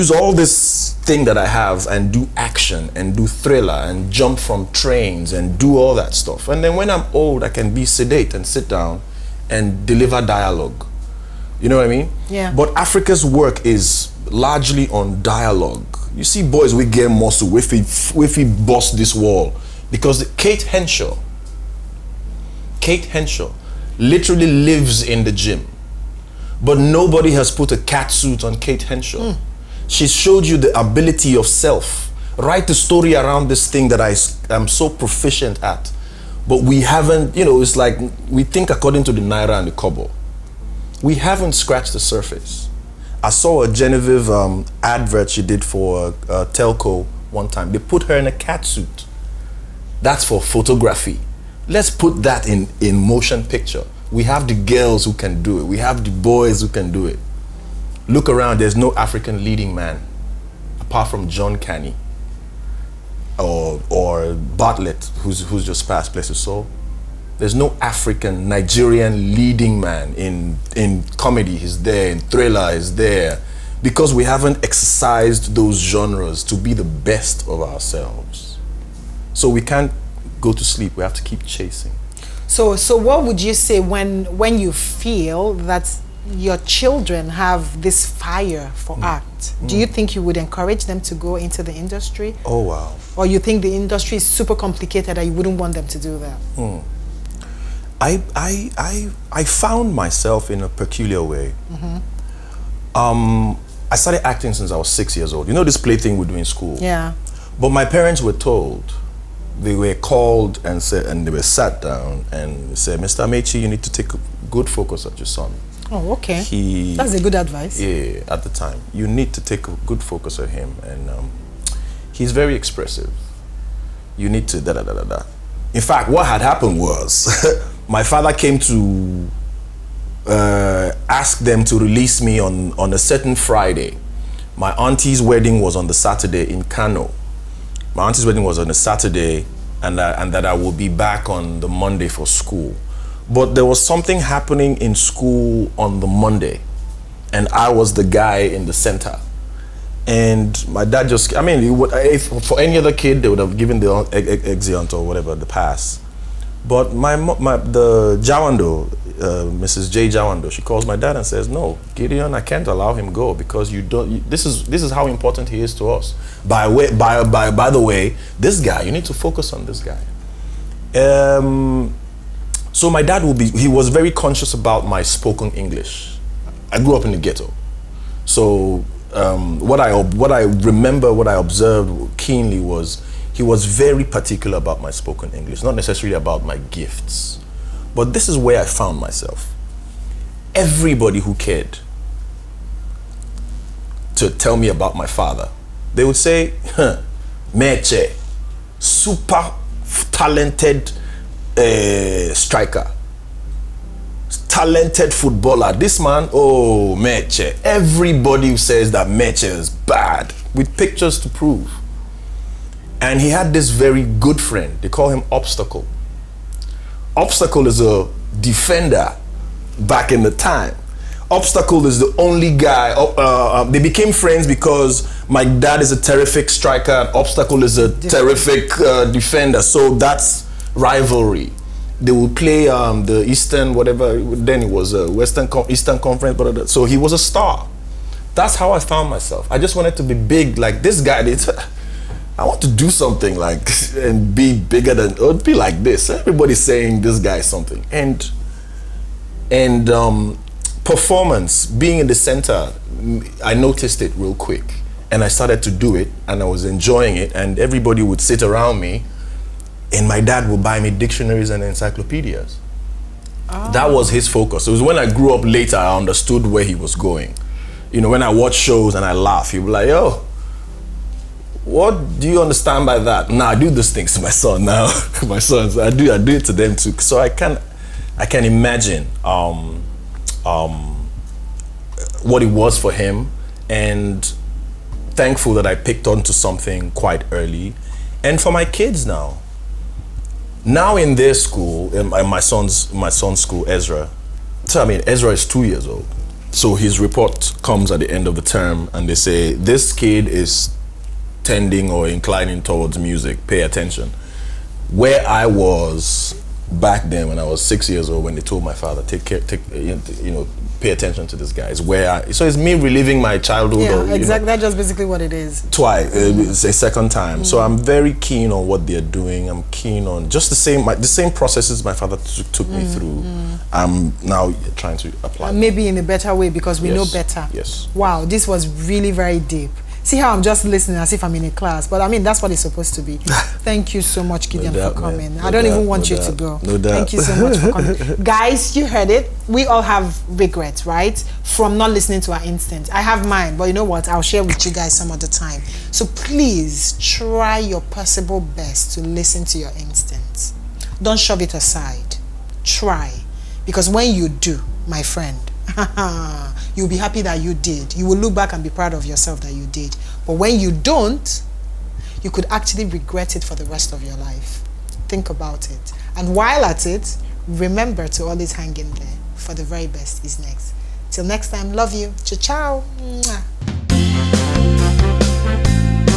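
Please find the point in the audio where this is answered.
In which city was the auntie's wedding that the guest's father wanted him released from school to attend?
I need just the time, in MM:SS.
02:16.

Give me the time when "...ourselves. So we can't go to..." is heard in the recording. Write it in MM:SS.
01:17.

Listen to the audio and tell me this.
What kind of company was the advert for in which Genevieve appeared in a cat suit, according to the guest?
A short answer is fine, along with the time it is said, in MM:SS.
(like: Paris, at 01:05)
a telco, at 00:46.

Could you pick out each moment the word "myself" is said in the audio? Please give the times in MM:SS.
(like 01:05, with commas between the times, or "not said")
01:39, 03:08, 03:59.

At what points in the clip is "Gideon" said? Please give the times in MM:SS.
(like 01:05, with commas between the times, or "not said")
02:41, 05:34.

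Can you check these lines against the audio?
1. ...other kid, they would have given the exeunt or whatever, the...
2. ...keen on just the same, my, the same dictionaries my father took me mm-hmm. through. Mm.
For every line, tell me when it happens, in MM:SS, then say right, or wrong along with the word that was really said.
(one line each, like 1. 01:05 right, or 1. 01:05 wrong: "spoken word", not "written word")
1. 02:32 right
2. 05:19 wrong: "processes", not "dictionaries".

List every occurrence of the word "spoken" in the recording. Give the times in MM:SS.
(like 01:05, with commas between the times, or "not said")
02:55, 03:04.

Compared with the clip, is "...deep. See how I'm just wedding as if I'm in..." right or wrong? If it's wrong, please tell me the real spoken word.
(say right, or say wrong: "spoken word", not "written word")
wrong: "listening", not "wedding".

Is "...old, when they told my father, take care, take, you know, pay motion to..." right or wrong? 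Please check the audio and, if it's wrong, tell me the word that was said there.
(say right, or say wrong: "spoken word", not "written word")
wrong: "attention", not "motion".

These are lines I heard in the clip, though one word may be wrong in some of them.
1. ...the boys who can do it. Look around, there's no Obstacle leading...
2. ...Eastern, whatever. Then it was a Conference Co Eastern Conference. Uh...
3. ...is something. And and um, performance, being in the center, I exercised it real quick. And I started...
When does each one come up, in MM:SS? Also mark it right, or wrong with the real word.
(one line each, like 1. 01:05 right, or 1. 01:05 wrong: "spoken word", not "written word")
1. 00:56 wrong: "African", not "Obstacle"
2. 03:53 wrong: "Western", not "Conference"
3. 04:07 wrong: "noticed", not "exercised".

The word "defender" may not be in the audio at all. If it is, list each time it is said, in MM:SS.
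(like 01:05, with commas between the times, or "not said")
03:38, 03:49.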